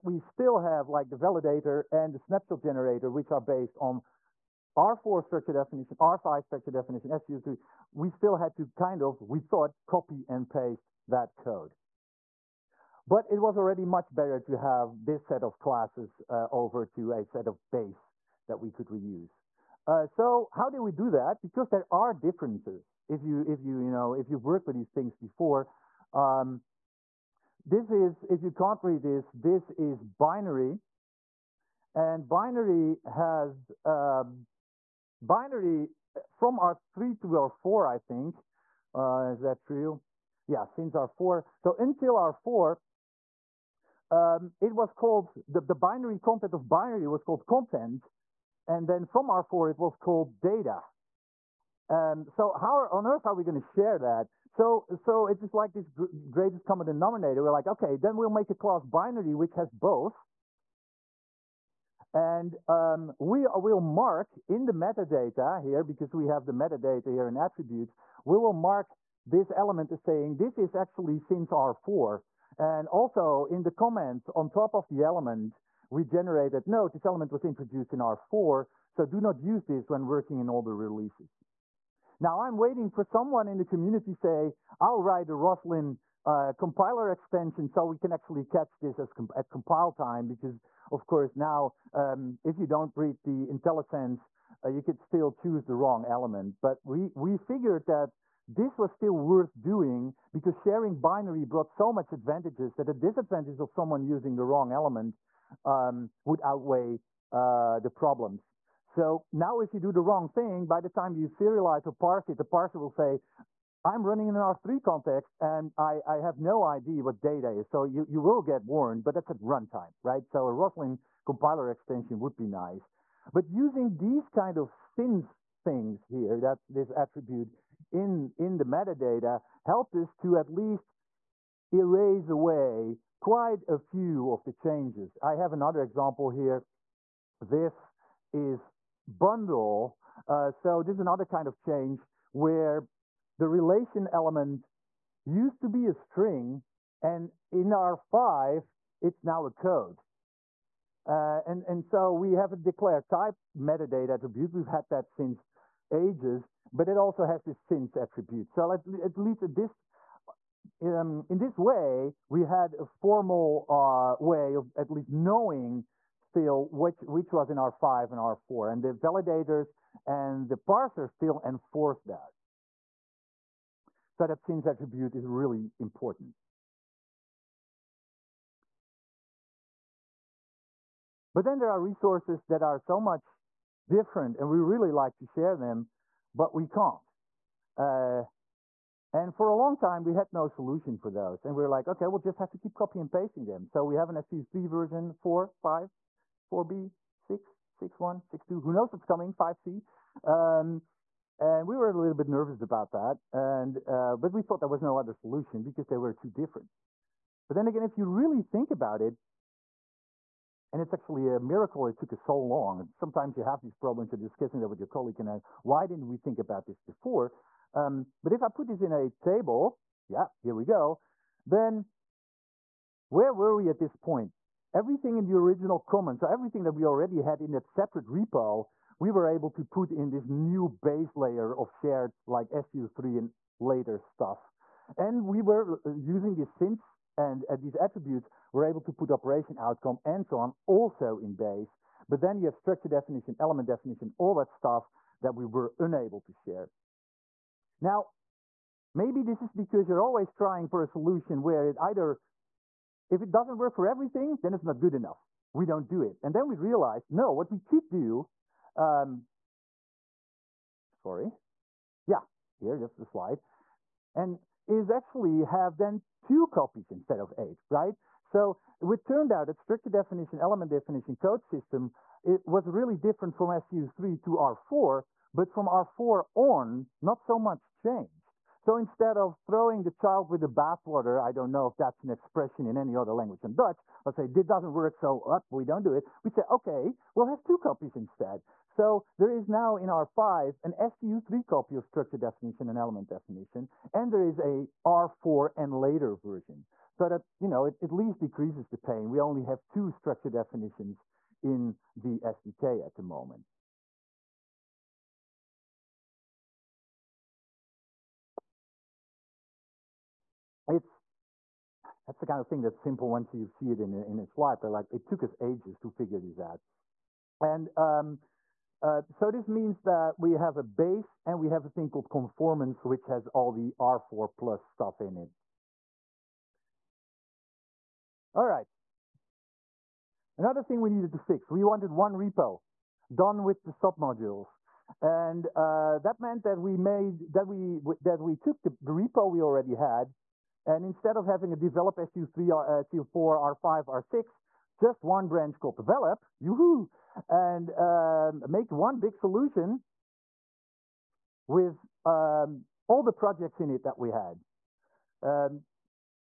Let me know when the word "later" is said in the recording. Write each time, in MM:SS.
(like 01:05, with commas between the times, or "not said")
03:53, 04:55.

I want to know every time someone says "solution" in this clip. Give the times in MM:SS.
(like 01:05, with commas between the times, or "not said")
03:10, 03:25, 04:10, 05:49.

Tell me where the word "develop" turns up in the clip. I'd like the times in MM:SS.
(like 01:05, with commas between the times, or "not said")
05:41, 05:45.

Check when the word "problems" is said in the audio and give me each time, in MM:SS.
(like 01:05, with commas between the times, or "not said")
01:47, 03:33.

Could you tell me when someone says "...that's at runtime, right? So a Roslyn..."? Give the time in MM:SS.
01:59.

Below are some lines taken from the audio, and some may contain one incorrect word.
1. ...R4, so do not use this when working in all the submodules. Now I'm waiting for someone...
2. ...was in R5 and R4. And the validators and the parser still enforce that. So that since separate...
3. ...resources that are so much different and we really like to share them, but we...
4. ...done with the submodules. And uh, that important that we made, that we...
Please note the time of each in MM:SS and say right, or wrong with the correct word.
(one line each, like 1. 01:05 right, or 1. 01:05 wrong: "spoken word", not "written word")
1. 01:17 wrong: "releases", not "submodules"
2. 02:47 wrong: "attribute", not "separate"
3. 03:01 right
4. 05:33 wrong: "meant", not "important".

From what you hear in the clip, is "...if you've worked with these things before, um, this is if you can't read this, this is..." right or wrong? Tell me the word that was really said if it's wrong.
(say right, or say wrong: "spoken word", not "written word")
right.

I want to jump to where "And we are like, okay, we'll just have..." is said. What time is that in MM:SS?
03:11.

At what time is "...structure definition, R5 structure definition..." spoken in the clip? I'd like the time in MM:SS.
00:05.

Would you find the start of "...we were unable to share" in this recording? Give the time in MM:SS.
04:05.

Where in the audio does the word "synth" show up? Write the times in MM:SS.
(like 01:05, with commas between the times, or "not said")
02:04, 03:56.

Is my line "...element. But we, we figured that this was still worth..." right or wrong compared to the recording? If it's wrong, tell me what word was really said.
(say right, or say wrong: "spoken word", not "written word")
right.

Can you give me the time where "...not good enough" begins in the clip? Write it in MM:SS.
04:14.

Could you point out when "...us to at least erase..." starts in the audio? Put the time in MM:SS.
02:09.